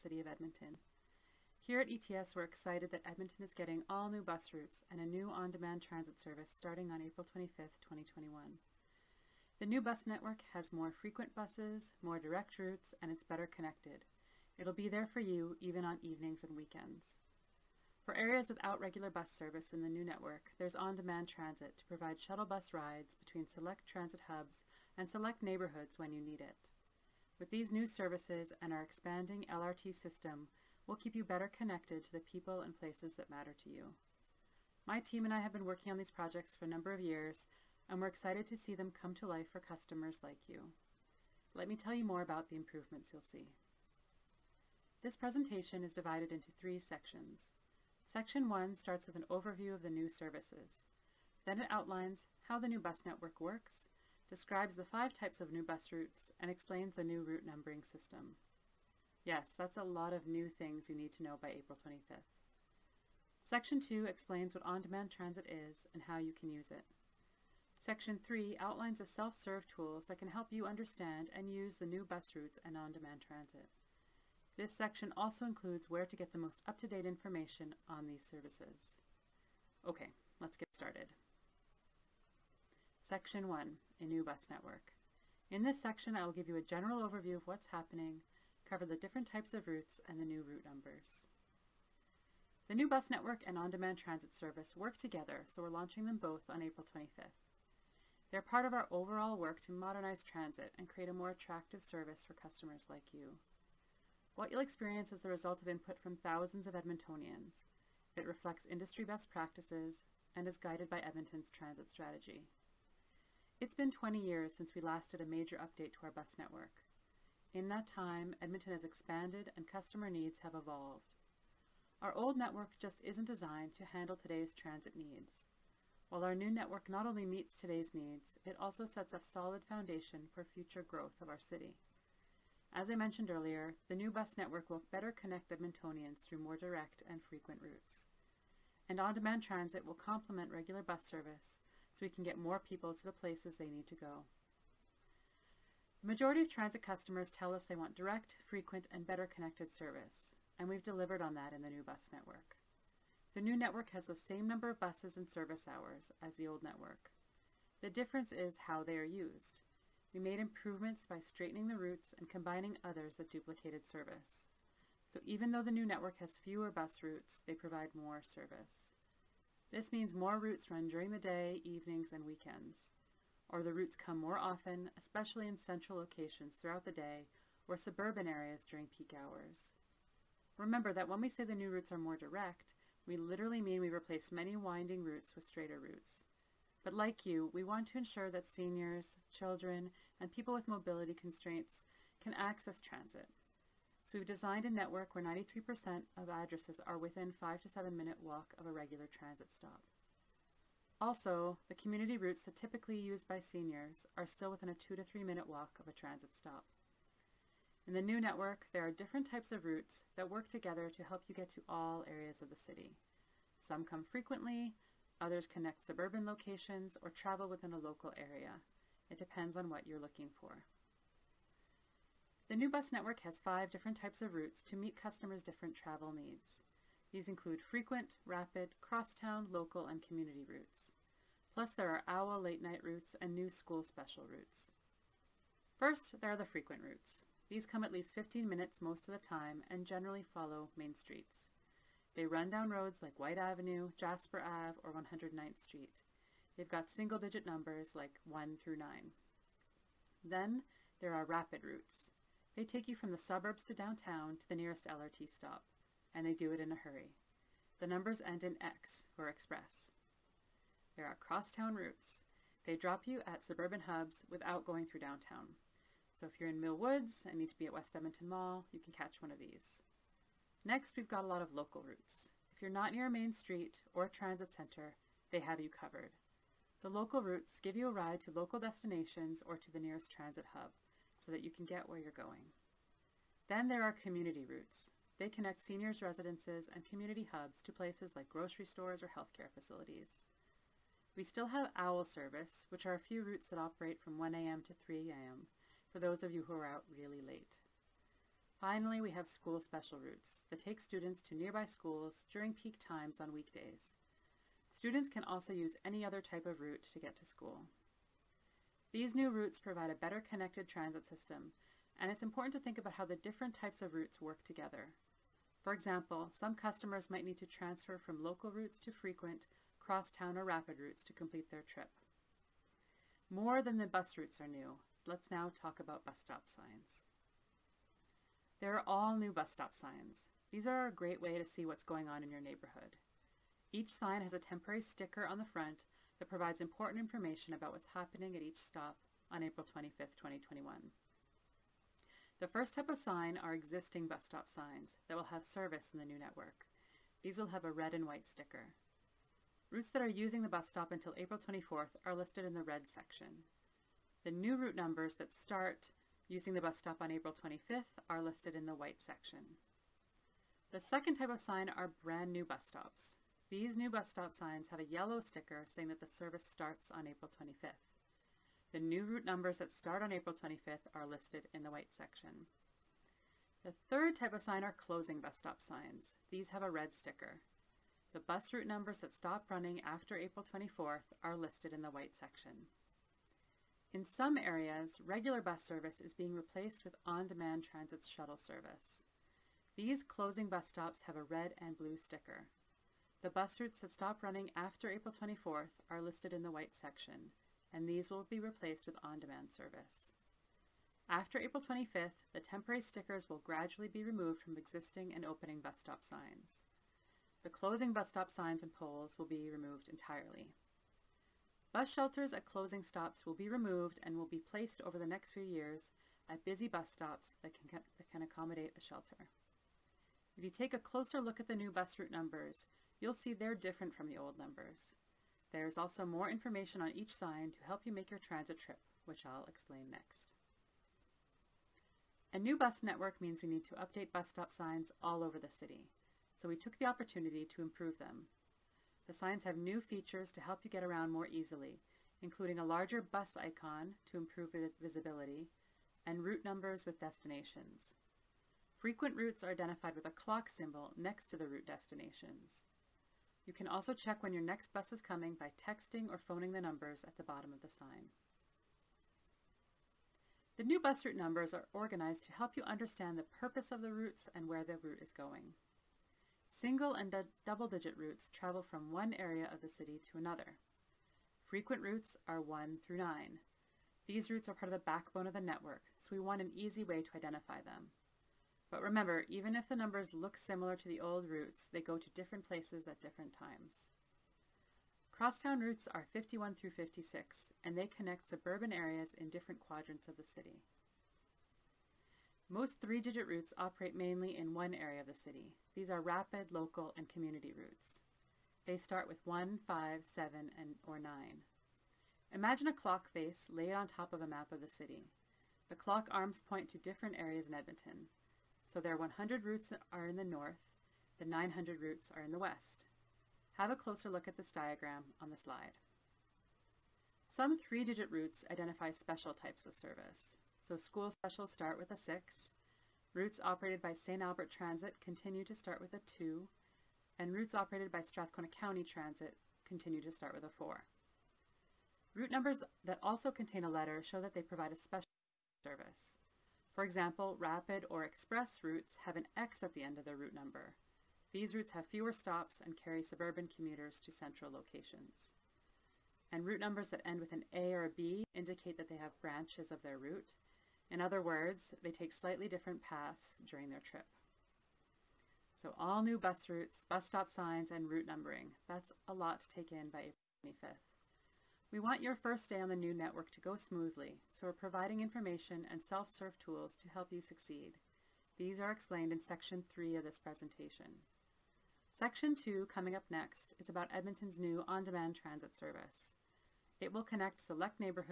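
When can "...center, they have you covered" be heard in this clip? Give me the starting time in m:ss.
4:34.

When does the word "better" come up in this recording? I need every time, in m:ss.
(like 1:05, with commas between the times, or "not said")
0:13, 0:31, 2:14, 2:29, 5:09.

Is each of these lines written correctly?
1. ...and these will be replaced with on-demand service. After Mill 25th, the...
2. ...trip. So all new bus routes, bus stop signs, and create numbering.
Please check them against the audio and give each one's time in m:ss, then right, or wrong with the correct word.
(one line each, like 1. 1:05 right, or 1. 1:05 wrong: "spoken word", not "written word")
1. 6:37 wrong: "April", not "Mill"
2. 9:13 wrong: "route", not "create".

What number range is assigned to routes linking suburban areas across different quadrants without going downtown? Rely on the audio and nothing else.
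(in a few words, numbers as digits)
51 through 56.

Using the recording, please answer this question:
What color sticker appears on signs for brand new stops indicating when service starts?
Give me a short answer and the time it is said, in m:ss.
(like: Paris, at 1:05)
Yellow, at 6:04.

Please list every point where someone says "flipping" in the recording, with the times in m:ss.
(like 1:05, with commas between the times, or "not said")
not said.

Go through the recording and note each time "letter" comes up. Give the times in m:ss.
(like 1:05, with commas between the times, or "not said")
8:53.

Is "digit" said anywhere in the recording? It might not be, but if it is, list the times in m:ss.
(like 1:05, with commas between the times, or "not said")
4:06, 7:47, 8:12, 8:37.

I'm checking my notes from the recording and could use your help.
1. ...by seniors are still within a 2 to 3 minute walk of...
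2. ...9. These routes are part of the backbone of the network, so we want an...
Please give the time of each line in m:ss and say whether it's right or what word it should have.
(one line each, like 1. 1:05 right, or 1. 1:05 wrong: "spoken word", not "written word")
1. 3:23 right
2. 7:52 right.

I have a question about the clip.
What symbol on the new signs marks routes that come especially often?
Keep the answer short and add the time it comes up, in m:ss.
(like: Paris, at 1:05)
A clock symbol, at 7:30.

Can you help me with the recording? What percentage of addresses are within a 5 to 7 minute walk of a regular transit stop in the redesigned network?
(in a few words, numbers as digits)
93%.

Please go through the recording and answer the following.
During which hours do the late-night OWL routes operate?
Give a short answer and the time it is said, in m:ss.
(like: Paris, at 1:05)
1 a.m. 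to 3 a.m., at 4:54.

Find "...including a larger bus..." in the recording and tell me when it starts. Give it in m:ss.
7:22.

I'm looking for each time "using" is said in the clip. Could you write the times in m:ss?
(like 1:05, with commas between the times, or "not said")
5:50, 5:56.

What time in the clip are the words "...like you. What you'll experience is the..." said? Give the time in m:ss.
1:42.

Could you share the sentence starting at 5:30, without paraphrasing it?
These are a great way to see what's going on in your neighborhood.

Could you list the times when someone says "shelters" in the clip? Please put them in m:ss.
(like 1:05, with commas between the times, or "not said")
6:51, 6:58.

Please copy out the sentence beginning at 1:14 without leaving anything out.
This section also includes where to get the most up-to-date information on these services.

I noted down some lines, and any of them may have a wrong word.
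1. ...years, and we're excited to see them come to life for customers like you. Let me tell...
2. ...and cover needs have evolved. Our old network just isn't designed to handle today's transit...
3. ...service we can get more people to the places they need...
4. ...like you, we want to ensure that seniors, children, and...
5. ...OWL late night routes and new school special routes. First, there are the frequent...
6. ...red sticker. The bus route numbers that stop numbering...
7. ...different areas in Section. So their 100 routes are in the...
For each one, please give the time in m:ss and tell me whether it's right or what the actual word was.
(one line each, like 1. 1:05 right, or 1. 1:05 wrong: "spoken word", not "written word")
1. 0:36 right
2. 1:59 wrong: "customer", not "cover"
3. 2:21 right
4. 3:06 right
5. 3:52 right
6. 6:16 wrong: "running", not "numbering"
7. 8:26 wrong: "Edmonton", not "Section".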